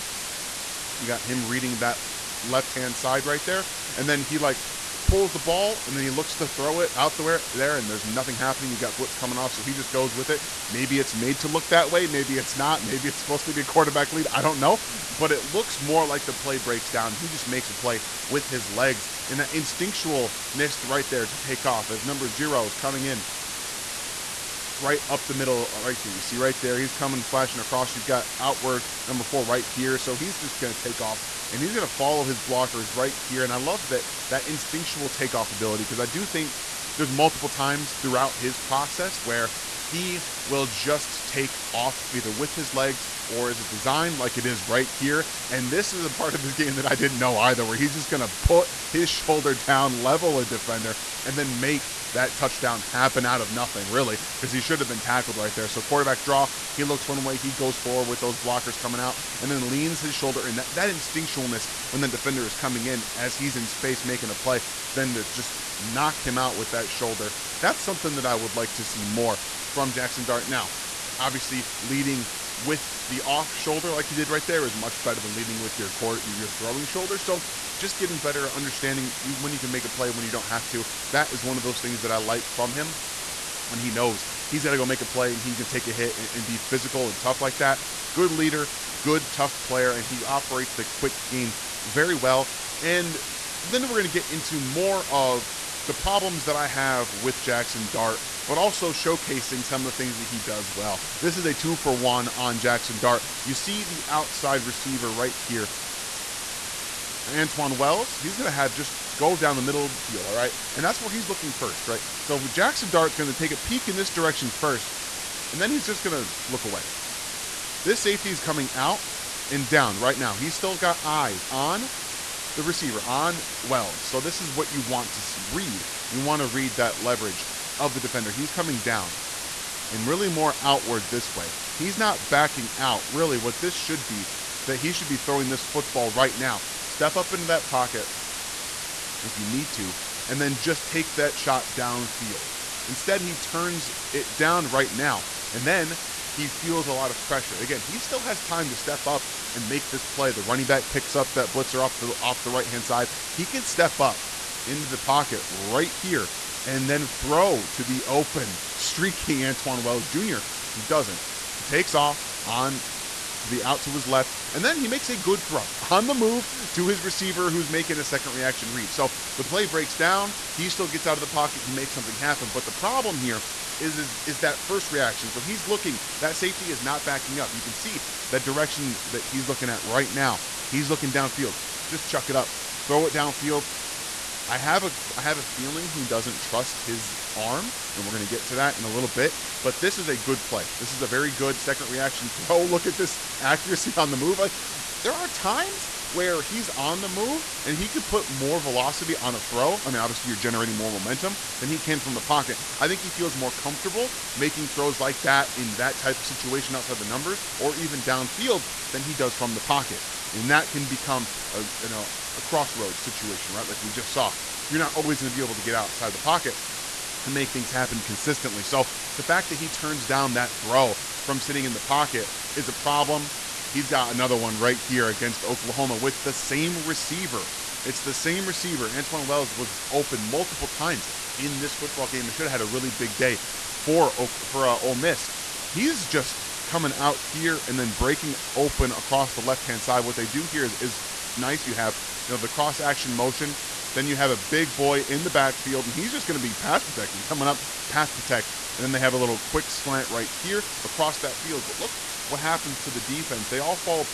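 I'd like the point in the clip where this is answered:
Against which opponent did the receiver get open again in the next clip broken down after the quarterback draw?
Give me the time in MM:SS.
03:45.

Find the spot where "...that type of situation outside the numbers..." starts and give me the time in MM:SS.
03:25.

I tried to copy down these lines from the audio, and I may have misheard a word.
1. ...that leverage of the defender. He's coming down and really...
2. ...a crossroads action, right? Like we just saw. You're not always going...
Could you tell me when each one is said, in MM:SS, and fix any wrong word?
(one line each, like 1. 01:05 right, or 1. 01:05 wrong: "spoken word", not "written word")
1. 02:06 right
2. 03:32 wrong: "situation", not "action".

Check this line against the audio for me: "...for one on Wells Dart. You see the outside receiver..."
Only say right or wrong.
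wrong.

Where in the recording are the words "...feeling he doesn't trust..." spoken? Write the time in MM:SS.
03:05.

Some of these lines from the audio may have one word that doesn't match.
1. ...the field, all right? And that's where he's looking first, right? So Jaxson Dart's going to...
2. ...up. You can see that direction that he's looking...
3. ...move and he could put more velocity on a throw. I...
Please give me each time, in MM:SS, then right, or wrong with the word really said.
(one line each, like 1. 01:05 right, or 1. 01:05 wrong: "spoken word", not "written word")
1. 01:49 right
2. 02:57 right
3. 03:17 right.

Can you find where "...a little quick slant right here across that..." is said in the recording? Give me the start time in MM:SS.
04:09.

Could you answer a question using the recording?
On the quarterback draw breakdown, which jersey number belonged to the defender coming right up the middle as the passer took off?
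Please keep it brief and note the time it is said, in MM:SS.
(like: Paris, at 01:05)
0, at 00:22.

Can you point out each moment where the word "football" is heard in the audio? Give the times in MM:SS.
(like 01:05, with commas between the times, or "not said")
02:15, 03:51.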